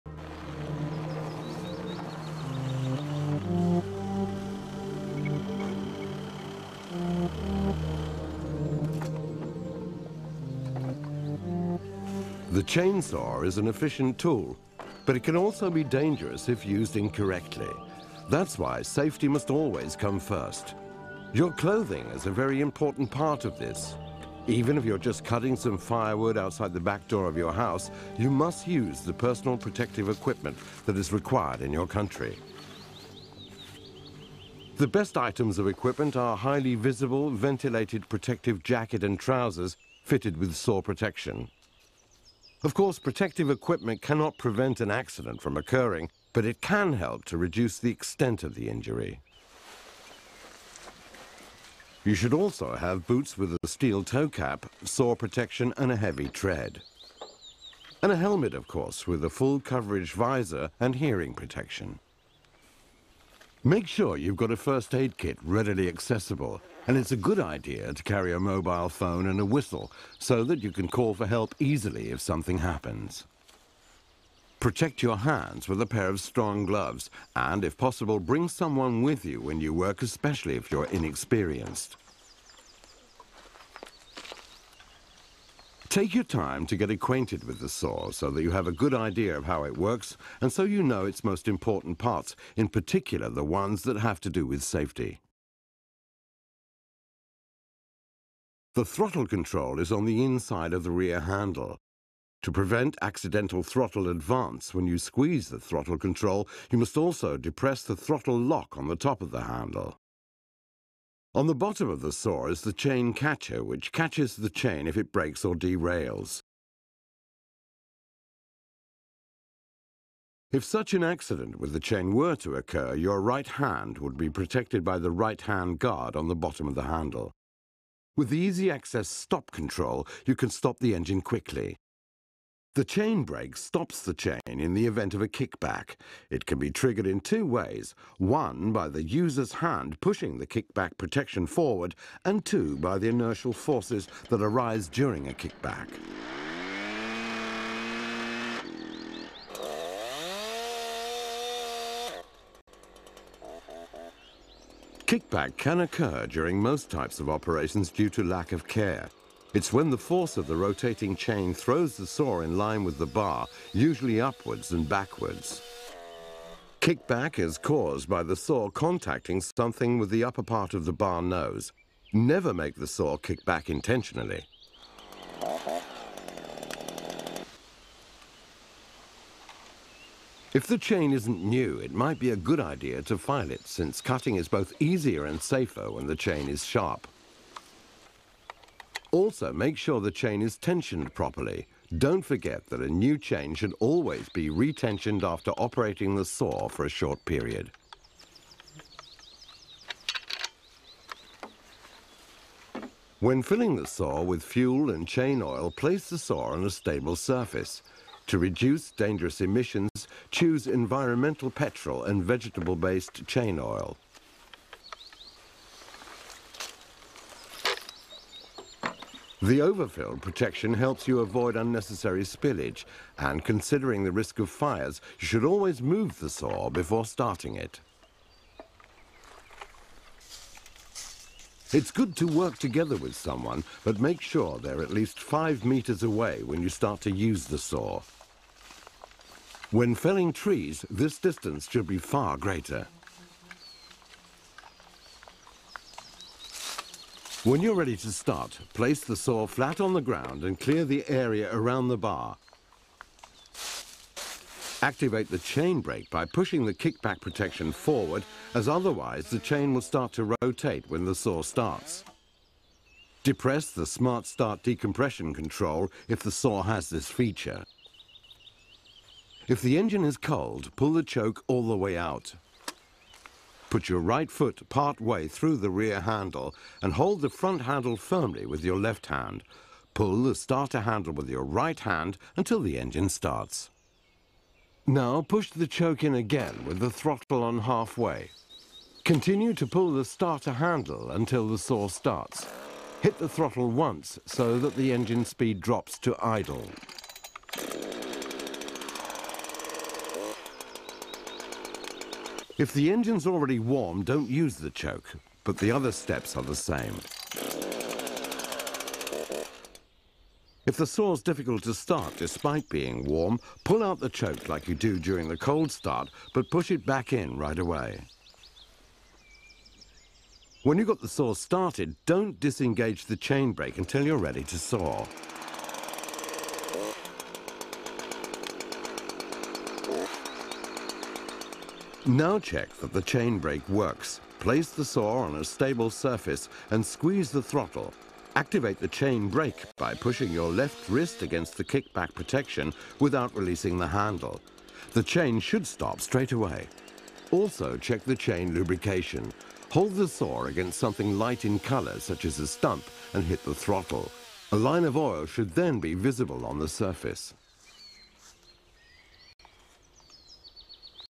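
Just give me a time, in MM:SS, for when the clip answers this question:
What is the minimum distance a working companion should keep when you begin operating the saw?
03:55.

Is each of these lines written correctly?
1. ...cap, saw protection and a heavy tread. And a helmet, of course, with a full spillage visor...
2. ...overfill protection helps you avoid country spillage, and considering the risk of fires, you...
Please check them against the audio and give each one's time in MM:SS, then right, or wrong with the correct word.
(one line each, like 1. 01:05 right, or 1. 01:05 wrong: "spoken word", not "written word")
1. 00:54 wrong: "coverage", not "spillage"
2. 03:39 wrong: "unnecessary", not "country".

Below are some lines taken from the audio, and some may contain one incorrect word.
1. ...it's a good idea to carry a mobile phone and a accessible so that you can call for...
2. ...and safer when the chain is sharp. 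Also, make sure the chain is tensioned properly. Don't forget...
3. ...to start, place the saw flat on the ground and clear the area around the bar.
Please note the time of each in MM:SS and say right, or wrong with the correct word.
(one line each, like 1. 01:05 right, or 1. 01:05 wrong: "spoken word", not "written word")
1. 01:06 wrong: "whistle", not "accessible"
2. 03:05 right
3. 04:07 right.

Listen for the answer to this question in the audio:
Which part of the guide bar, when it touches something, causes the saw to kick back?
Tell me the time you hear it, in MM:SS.
02:50.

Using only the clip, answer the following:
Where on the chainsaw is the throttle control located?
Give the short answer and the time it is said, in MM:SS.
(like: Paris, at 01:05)
inside of the rear handle, at 01:39.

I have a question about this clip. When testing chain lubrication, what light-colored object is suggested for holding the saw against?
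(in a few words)
a stump.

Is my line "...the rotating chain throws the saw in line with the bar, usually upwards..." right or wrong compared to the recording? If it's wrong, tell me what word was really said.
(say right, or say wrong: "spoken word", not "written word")
right.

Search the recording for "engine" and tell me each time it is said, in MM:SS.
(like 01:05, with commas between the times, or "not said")
02:10, 04:29, 04:42, 04:54, 05:02.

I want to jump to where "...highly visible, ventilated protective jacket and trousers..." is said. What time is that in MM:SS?
00:36.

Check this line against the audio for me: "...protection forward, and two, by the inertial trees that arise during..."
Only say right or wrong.
wrong.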